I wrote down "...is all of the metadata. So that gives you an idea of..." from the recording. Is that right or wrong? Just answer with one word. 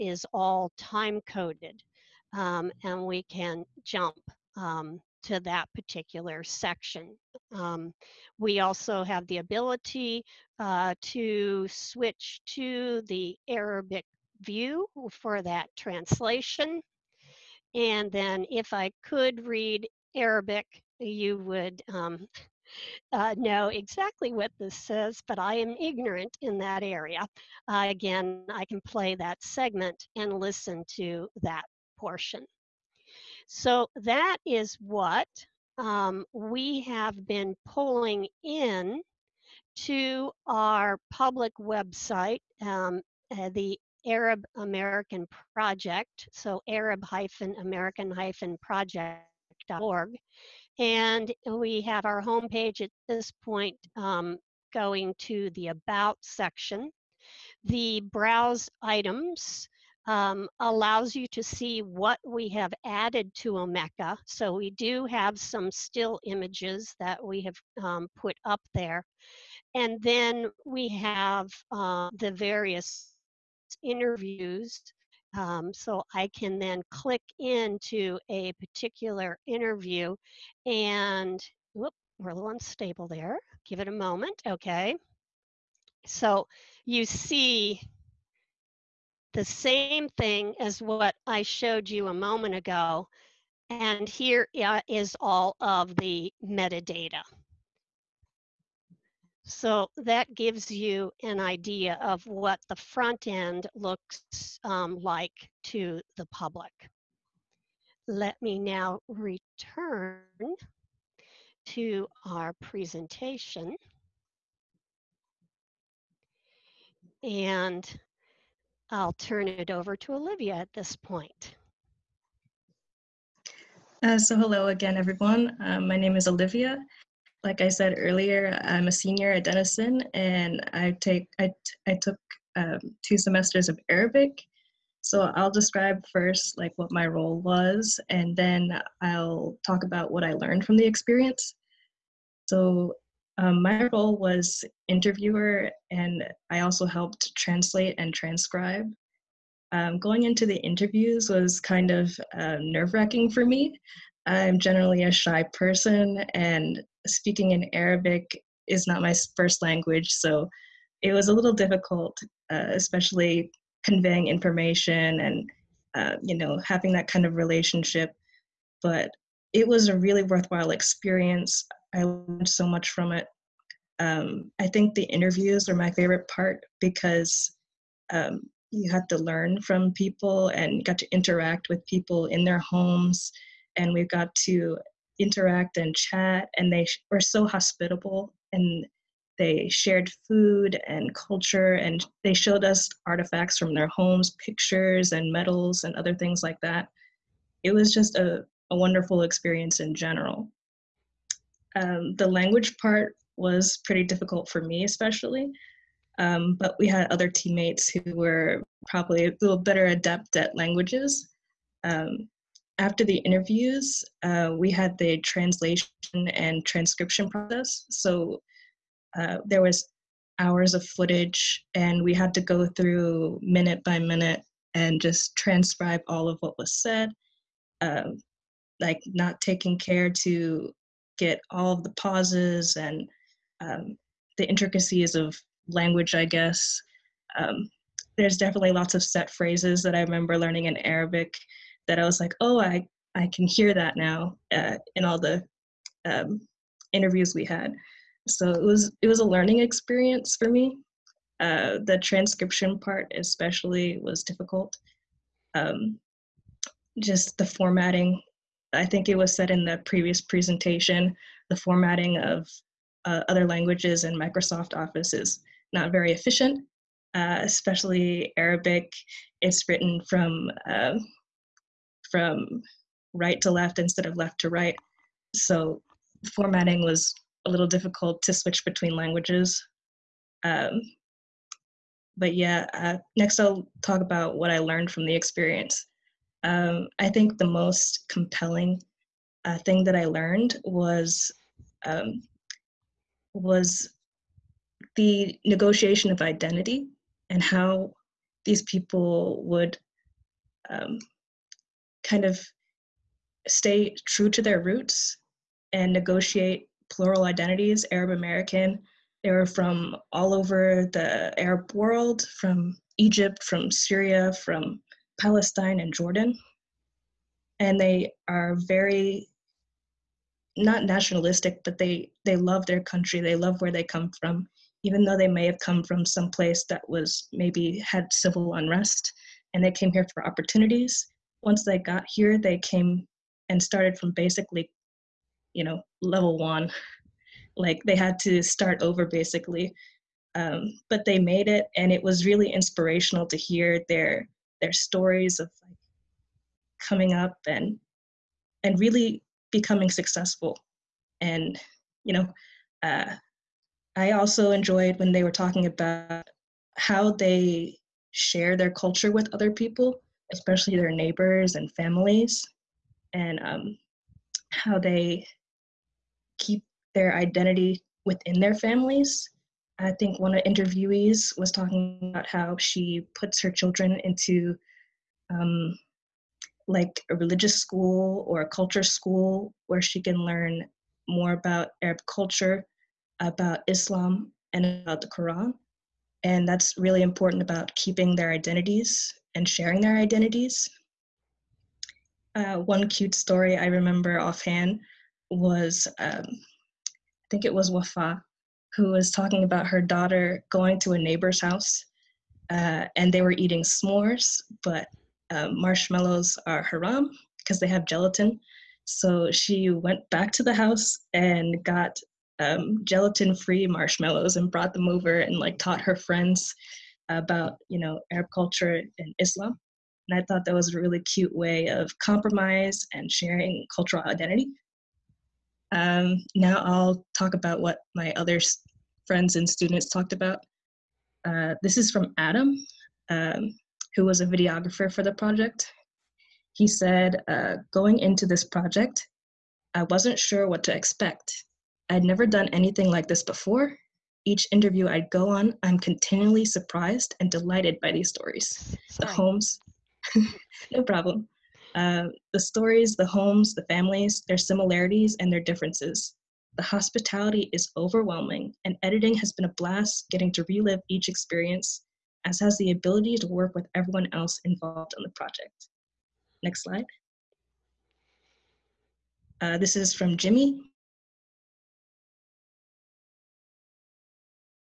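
right.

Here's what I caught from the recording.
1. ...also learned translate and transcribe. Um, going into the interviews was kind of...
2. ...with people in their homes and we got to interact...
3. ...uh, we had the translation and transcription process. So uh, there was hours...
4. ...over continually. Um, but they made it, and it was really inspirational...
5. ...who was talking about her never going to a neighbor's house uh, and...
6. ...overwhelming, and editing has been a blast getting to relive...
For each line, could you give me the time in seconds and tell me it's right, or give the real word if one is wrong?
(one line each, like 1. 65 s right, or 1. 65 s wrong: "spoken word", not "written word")
1. 146 s wrong: "helped", not "learned"
2. 181 s right
3. 214 s right
4. 338 s wrong: "basically", not "continually"
5. 398 s wrong: "daughter", not "never"
6. 457 s right.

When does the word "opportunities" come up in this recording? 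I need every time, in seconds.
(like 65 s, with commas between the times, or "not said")
330 s.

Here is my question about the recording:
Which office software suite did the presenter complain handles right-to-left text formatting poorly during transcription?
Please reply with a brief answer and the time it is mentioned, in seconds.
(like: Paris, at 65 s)
Microsoft Office, at 264 s.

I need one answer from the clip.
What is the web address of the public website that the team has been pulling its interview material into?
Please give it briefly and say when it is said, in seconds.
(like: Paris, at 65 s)
Arab-American-Project.org, at 46 s.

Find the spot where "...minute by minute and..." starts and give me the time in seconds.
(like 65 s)
223 s.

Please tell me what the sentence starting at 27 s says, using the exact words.
Uh, again, I can play that segment and listen to that portion.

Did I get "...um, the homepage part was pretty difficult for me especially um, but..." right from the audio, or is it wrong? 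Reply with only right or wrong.
wrong.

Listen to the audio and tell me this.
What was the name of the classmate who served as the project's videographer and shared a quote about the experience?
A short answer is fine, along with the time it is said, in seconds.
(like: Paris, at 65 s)
Adam, at 432 s.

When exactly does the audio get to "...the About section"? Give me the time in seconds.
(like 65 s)
55 s.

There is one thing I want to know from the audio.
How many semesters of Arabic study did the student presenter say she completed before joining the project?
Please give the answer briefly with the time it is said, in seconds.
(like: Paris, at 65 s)
2, at 133 s.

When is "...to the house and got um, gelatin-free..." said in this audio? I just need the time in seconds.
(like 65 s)
410 s.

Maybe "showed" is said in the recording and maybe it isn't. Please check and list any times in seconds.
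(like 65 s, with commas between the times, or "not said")
91 s, 192 s.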